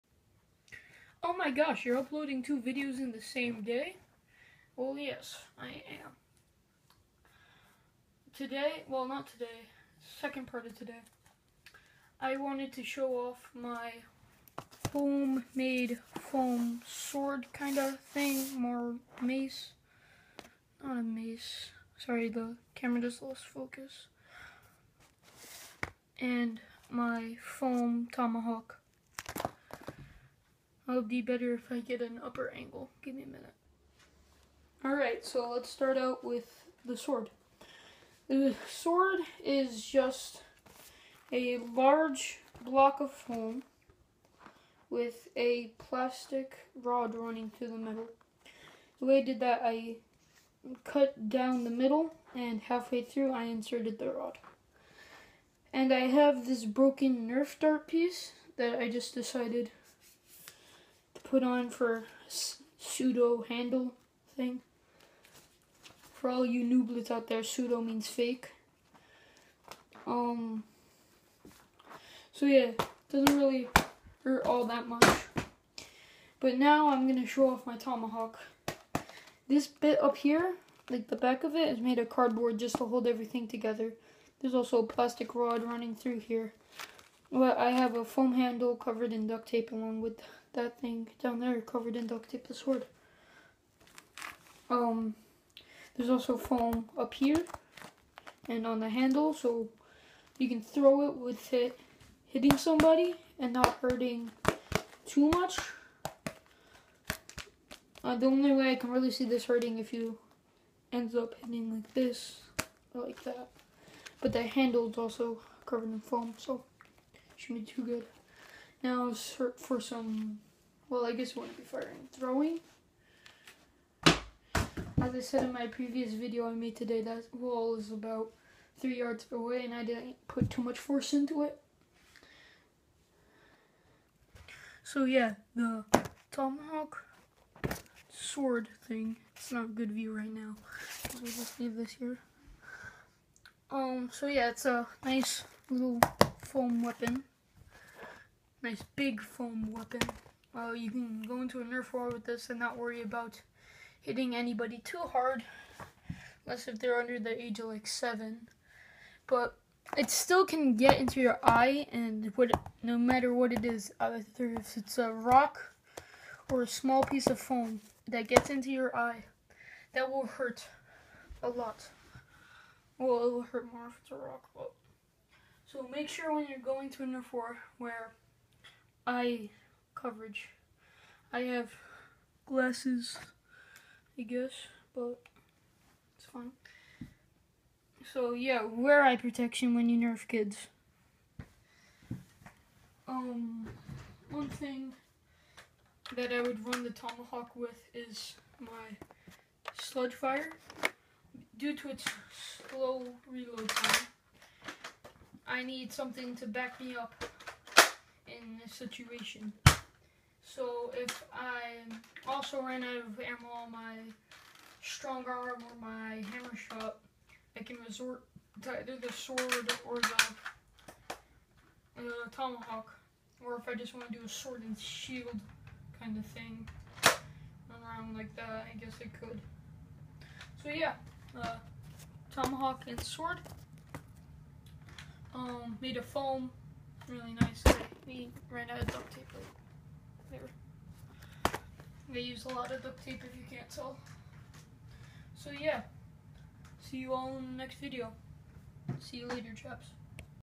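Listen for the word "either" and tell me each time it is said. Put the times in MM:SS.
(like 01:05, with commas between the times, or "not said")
02:43, 03:38.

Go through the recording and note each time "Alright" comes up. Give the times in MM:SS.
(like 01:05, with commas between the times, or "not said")
00:34.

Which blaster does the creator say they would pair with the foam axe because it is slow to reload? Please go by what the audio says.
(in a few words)
Sledgefire.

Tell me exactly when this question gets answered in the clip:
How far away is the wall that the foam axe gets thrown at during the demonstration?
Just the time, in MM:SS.
02:08.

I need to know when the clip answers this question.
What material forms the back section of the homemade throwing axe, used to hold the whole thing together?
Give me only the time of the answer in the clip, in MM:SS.
01:22.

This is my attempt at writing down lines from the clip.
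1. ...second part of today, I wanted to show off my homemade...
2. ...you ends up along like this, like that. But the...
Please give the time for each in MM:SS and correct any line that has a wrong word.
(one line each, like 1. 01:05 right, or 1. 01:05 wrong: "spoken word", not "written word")
1. 00:10 right
2. 01:49 wrong: "hitting", not "along".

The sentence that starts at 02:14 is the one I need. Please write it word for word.
So yeah, the tomahawk sword thing, it's not a good view right now.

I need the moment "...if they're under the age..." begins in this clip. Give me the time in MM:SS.
02:36.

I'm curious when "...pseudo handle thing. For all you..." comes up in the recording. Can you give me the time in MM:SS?
01:02.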